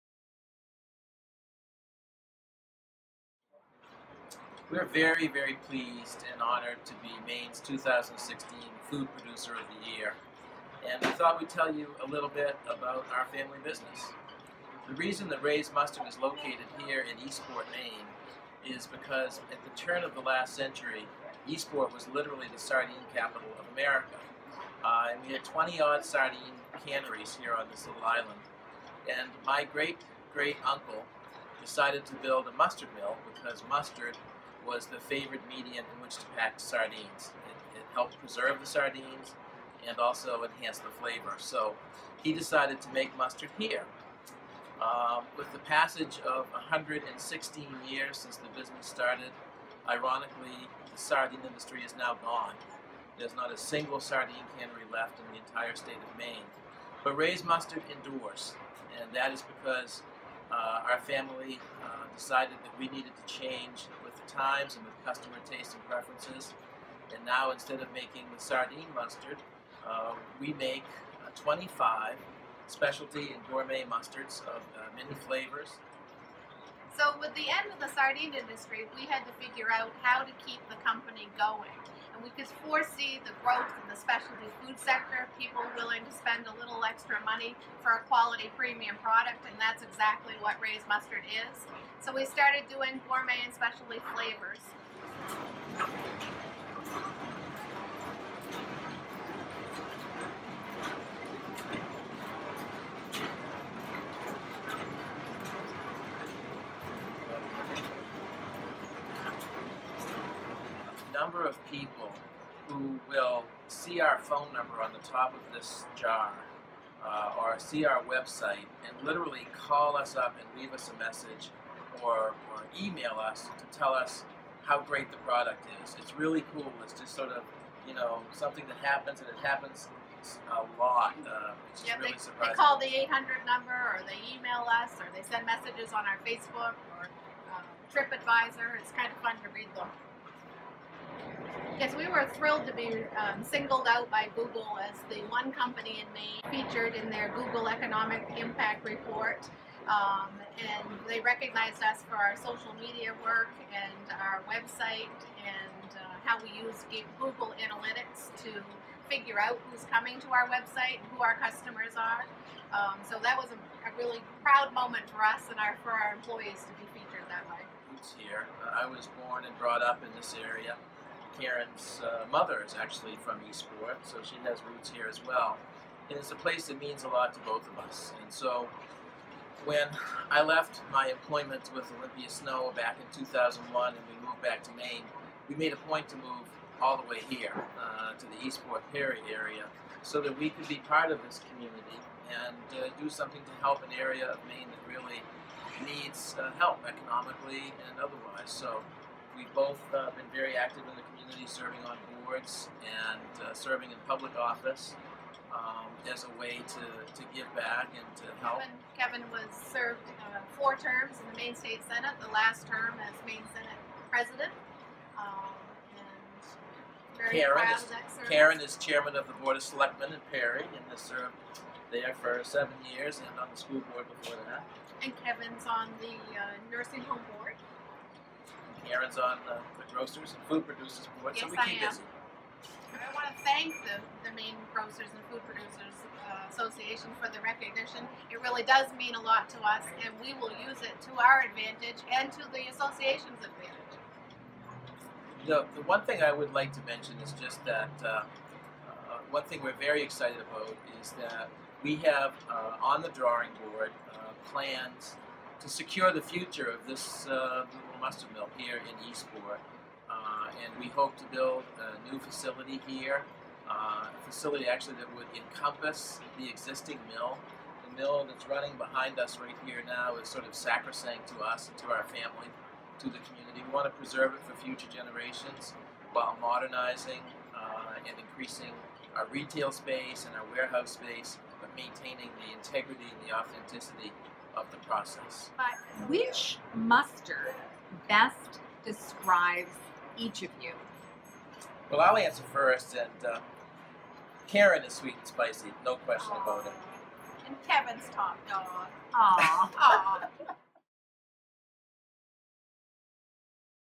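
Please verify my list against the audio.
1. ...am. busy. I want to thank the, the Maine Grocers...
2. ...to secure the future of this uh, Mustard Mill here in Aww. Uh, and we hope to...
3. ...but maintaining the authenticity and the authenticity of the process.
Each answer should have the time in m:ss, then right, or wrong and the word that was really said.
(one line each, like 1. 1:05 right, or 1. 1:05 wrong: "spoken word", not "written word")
1. 3:51 right
2. 4:15 wrong: "Eastport", not "Aww"
3. 4:41 wrong: "integrity", not "authenticity".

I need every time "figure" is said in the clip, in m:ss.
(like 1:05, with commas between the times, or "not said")
1:19, 2:39.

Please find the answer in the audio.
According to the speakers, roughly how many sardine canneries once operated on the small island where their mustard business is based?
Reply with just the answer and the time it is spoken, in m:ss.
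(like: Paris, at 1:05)
20, at 0:25.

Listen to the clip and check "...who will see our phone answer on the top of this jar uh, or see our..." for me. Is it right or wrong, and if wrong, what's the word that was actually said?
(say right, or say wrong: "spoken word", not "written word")
wrong: "number", not "answer".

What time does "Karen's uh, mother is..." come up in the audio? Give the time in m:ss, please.
2:51.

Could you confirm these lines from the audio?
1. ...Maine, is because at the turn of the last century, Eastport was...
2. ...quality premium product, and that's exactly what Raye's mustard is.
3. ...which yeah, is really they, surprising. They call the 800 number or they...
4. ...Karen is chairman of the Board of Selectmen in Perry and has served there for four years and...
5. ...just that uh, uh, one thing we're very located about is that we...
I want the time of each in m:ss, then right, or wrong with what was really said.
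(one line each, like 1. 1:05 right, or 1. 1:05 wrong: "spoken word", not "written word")
1. 0:17 right
2. 1:28 right
3. 2:11 right
4. 3:38 wrong: "seven", not "four"
5. 4:07 wrong: "excited", not "located".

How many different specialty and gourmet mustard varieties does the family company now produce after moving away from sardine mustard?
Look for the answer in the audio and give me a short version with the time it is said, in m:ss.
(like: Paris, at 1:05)
25, at 1:11.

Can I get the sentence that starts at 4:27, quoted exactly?
The mill that's running behind us right here now is sort of sacrosanct to us and to our family, to the community.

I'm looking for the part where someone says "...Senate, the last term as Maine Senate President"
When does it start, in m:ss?
3:31.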